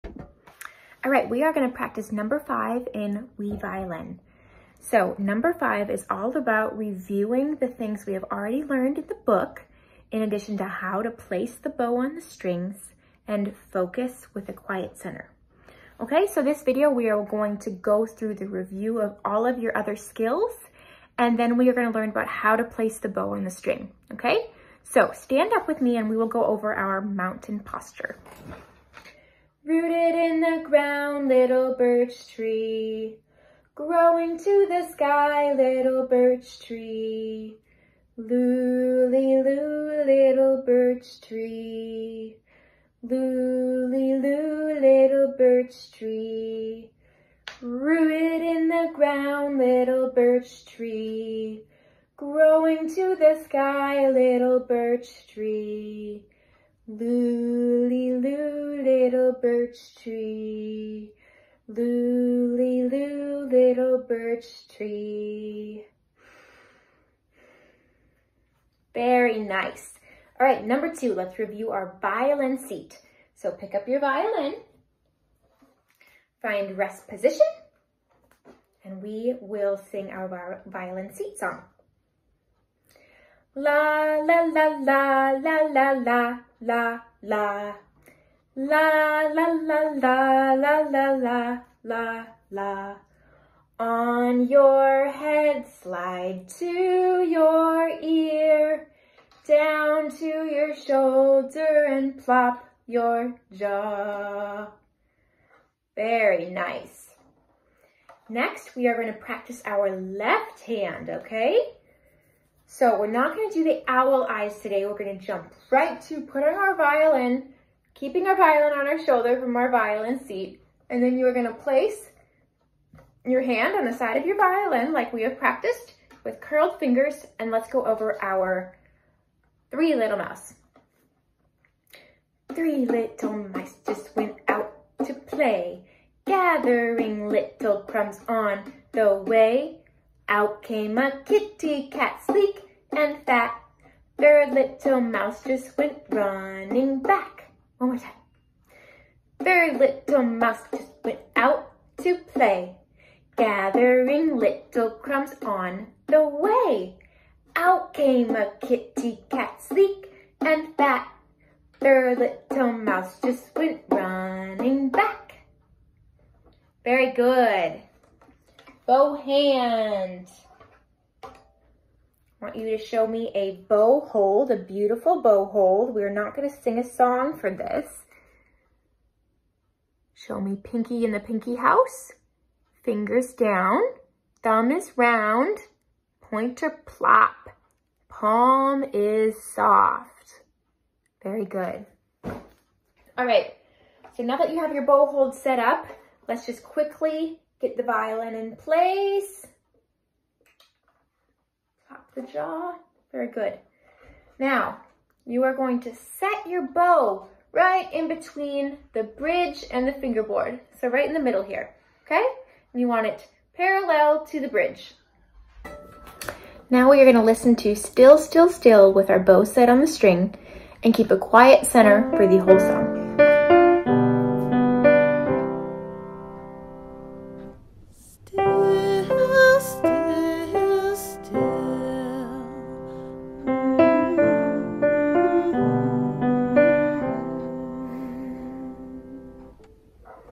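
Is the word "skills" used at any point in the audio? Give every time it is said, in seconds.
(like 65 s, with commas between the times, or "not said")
19 s.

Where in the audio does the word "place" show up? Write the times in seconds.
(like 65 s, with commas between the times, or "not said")
11 s, 22 s, 121 s, 198 s.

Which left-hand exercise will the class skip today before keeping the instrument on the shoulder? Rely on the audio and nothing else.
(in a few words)
owl eyes.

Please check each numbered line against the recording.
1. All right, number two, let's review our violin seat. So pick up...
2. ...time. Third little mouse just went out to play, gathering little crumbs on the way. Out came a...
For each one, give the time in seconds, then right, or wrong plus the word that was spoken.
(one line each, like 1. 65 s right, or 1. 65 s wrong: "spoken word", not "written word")
1. 70 s right
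2. 147 s right.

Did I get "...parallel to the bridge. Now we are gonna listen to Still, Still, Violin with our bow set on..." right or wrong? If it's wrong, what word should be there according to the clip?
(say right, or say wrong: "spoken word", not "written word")
wrong: "Still", not "Violin".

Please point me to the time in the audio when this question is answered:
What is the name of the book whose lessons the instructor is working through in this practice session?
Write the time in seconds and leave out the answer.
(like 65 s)
3 s.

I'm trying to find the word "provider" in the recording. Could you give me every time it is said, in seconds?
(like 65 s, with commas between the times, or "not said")
not said.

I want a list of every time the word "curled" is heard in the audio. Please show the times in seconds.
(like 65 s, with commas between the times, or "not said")
126 s.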